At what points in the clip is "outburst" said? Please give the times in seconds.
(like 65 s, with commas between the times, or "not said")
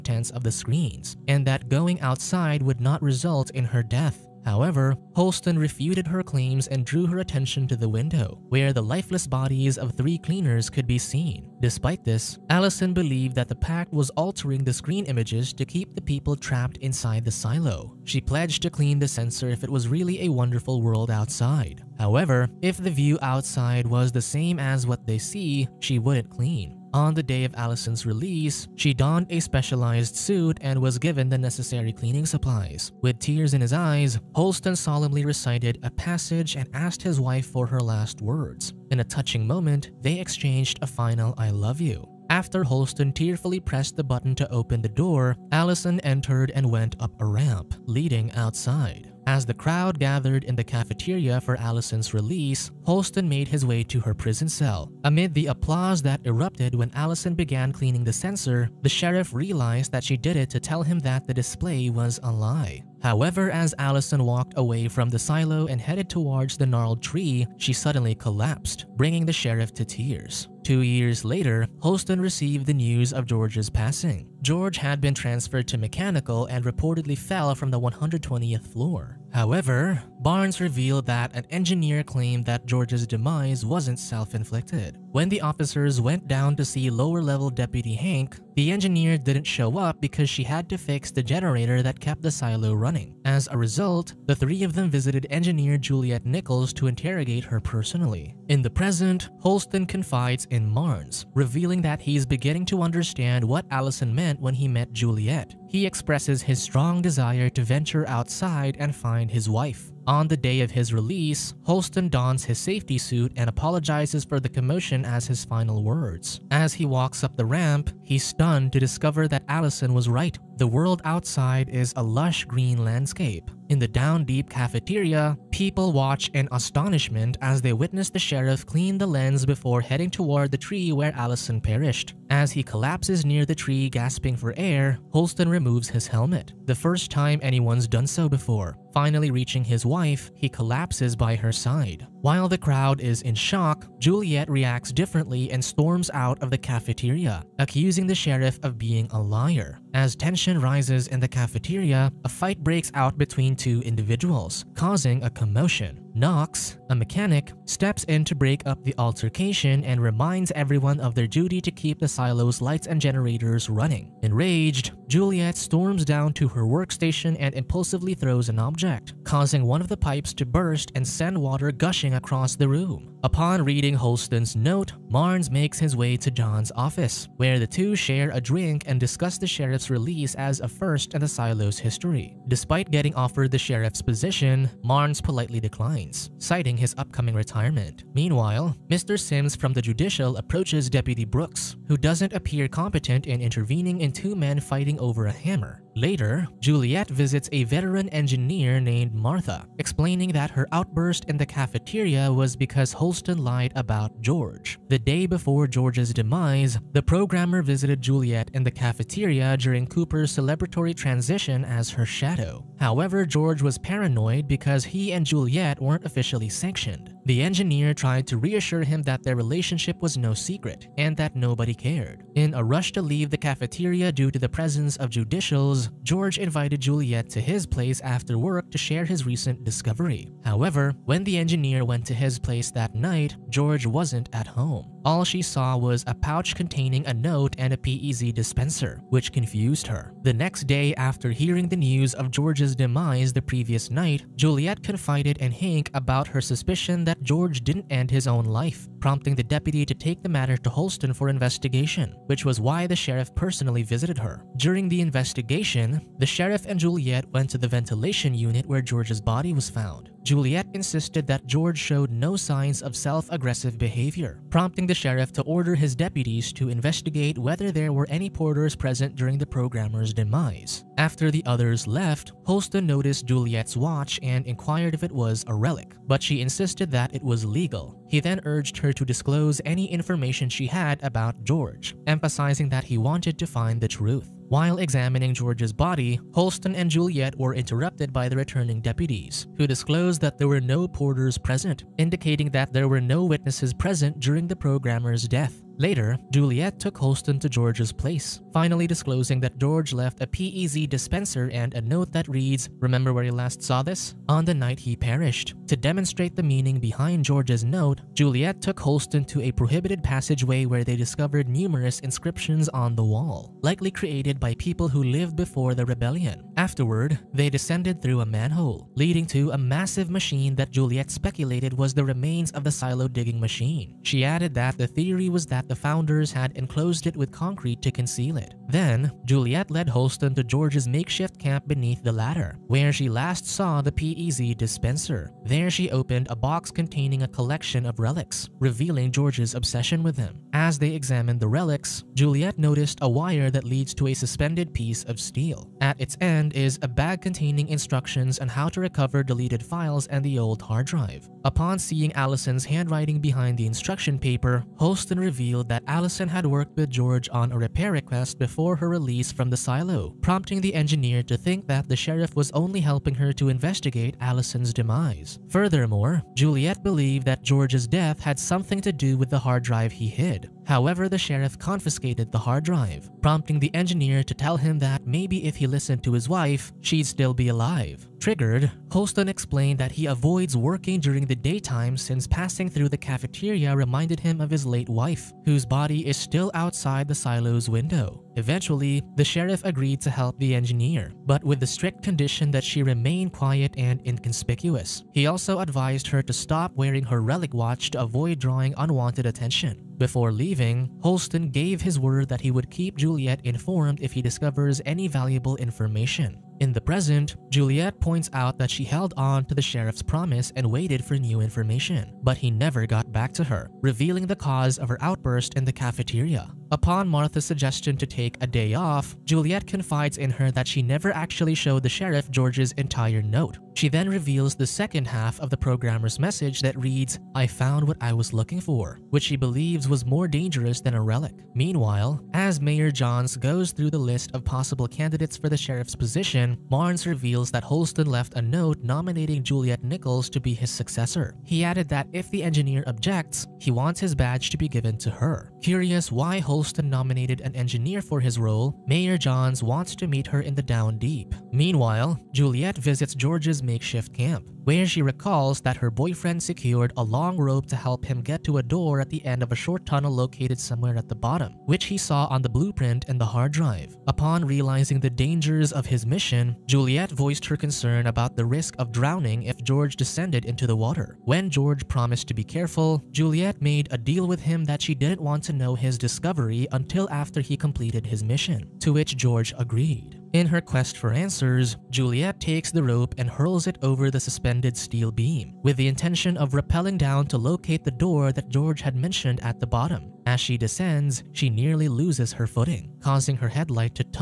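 200 s, 415 s.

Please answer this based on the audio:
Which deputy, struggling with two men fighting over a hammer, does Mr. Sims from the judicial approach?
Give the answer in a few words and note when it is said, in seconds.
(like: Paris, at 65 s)
Brooks, at 190 s.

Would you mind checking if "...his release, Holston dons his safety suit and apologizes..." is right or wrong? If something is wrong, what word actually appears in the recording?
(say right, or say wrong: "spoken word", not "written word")
right.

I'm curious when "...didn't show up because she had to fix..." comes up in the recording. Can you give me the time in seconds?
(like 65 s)
89 s.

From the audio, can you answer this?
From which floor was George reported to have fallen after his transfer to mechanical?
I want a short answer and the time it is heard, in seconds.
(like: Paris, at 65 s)
120th, at 77 s.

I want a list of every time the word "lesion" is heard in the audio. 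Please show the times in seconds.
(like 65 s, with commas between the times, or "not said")
not said.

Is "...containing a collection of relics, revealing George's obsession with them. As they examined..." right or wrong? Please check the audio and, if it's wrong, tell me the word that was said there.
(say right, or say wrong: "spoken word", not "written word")
right.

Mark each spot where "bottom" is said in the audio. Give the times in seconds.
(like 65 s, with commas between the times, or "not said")
461 s, 489 s.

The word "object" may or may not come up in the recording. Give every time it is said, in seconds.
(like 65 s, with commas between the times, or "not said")
168 s, 442 s.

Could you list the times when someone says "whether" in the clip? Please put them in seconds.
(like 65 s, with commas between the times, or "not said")
267 s.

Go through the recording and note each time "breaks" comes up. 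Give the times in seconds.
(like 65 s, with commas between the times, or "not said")
152 s, 158 s.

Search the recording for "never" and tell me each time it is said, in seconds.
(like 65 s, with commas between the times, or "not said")
412 s, 420 s.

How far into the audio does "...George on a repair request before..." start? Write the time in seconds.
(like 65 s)
356 s.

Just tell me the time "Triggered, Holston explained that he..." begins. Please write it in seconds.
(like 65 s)
378 s.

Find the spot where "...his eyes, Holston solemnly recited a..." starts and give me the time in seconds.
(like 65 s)
33 s.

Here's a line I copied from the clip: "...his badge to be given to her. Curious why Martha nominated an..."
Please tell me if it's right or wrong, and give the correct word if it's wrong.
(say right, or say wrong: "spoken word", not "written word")
wrong: "Holston", not "Martha".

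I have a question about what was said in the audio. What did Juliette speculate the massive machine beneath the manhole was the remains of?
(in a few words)
silo digging machine.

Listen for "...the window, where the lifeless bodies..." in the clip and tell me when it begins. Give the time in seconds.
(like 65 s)
7 s.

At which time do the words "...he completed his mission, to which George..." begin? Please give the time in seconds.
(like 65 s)
477 s.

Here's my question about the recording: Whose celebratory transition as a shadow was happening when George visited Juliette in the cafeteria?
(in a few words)
Cooper.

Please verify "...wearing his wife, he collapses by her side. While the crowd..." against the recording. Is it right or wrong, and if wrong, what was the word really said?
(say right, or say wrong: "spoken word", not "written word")
wrong: "reaching", not "wearing".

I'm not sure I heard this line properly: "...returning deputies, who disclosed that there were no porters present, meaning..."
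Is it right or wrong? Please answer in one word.
wrong.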